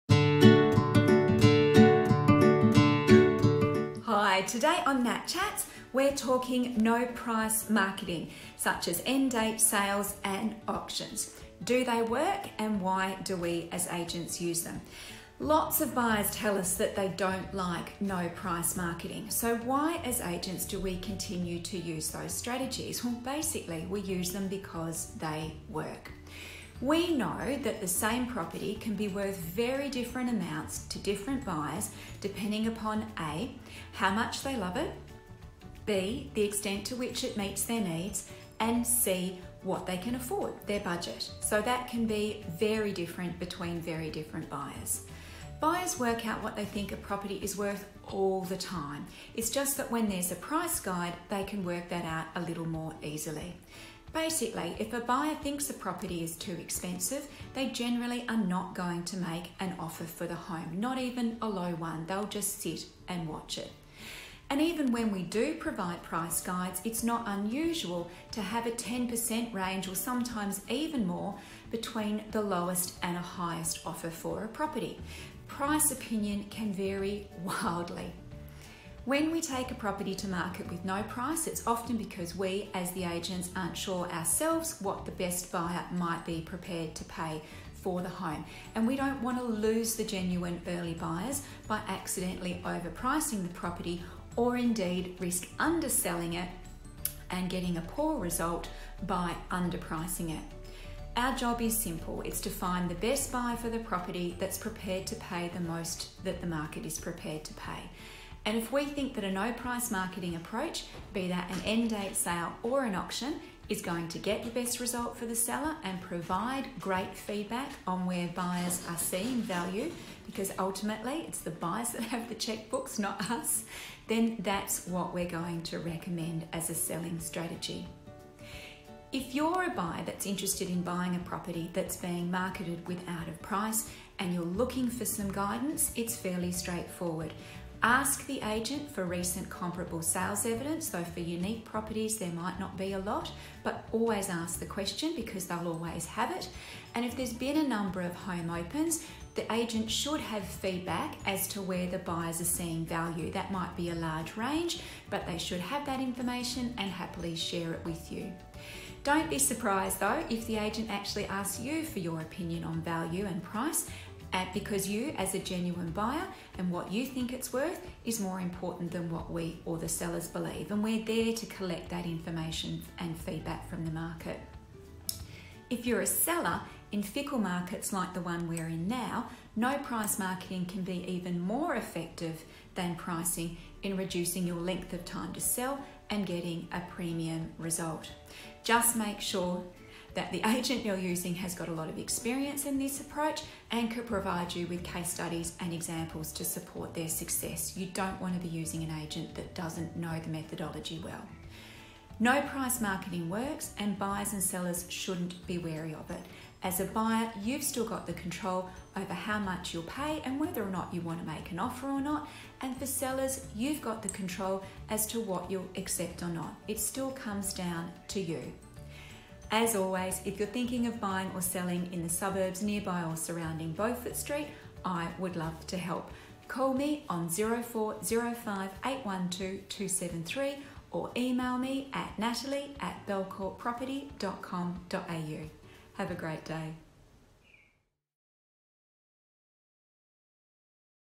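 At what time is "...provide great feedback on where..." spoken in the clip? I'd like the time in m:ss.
1:56.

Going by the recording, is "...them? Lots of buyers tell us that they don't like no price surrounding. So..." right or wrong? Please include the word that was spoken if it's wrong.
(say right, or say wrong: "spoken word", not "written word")
wrong: "marketing", not "surrounding".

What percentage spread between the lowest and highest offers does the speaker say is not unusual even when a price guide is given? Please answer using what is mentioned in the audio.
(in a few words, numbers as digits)
10%.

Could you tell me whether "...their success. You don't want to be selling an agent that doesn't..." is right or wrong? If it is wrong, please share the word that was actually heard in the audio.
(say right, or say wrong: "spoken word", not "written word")
wrong: "using", not "selling".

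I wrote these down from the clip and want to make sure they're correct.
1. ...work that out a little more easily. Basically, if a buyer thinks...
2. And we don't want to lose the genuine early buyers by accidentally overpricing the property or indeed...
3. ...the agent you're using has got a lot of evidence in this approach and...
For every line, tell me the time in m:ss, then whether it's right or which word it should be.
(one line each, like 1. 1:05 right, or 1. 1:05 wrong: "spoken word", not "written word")
1. 0:51 right
2. 1:28 right
3. 3:10 wrong: "experience", not "evidence".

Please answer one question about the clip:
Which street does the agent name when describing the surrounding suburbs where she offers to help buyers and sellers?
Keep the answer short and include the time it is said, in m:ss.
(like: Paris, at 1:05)
Beaufort Street, at 3:43.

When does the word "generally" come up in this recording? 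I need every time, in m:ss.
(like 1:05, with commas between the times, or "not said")
0:57.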